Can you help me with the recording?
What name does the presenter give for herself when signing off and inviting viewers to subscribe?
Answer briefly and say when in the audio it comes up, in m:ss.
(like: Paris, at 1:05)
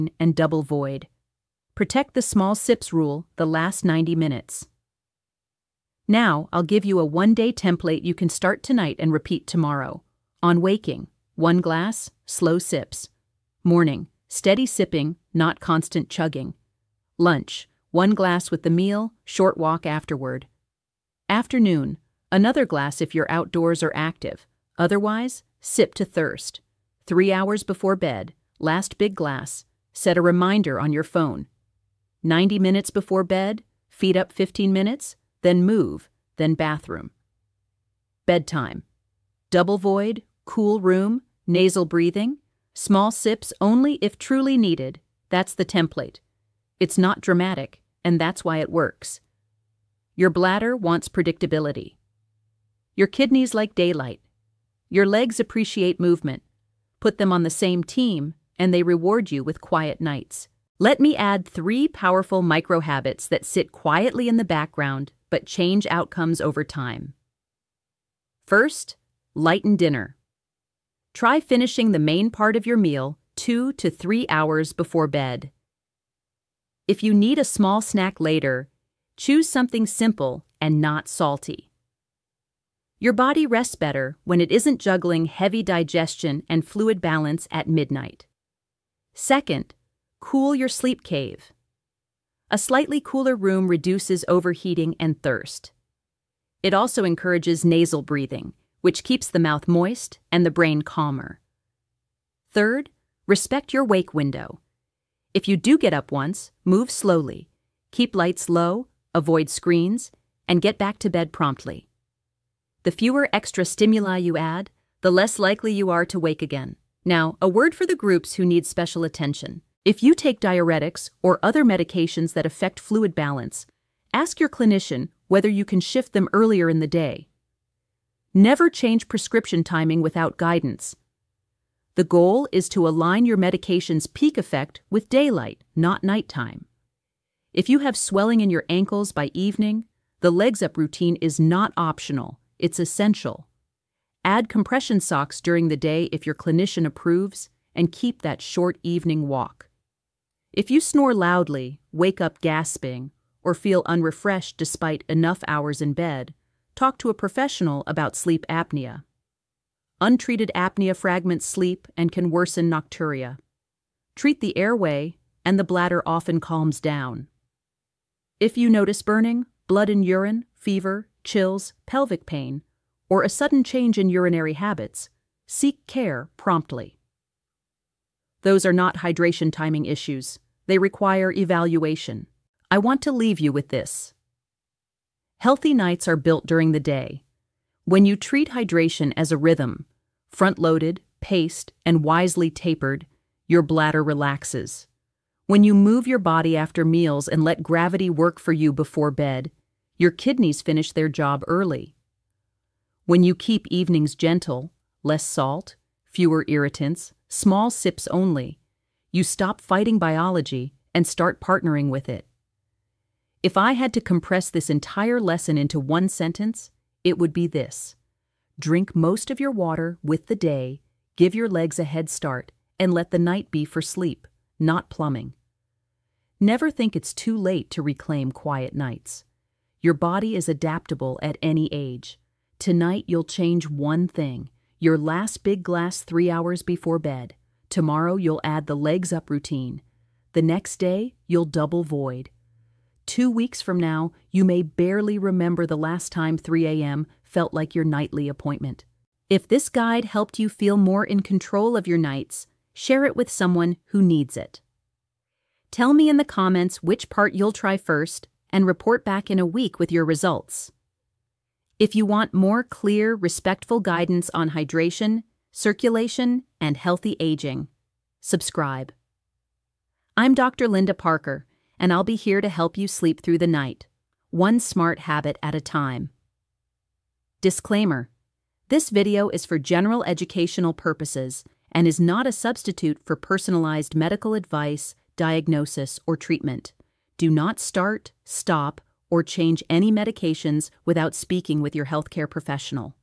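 Dr. Linda Parker, at 4:30.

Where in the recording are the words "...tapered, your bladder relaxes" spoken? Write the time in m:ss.
3:12.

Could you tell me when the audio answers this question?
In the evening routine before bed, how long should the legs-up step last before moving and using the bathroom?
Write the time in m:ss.
0:34.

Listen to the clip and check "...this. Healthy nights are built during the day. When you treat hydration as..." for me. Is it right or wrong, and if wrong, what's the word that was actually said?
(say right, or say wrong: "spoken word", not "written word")
right.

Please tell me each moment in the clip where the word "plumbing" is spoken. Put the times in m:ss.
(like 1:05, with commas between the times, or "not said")
3:44.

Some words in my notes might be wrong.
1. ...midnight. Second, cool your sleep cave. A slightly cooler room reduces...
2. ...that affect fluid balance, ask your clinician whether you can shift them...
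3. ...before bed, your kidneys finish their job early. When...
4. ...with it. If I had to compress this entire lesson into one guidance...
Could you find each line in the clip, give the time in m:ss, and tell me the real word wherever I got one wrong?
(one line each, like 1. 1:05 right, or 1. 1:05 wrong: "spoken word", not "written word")
1. 1:27 right
2. 2:02 right
3. 3:18 right
4. 3:31 wrong: "sentence", not "guidance".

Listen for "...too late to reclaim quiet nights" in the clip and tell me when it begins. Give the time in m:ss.
3:47.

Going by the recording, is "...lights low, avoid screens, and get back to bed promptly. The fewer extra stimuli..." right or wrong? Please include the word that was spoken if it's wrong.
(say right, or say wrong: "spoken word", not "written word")
right.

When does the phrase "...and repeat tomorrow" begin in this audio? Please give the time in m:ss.
0:08.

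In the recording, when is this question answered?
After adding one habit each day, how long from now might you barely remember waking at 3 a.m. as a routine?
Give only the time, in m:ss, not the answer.
4:03.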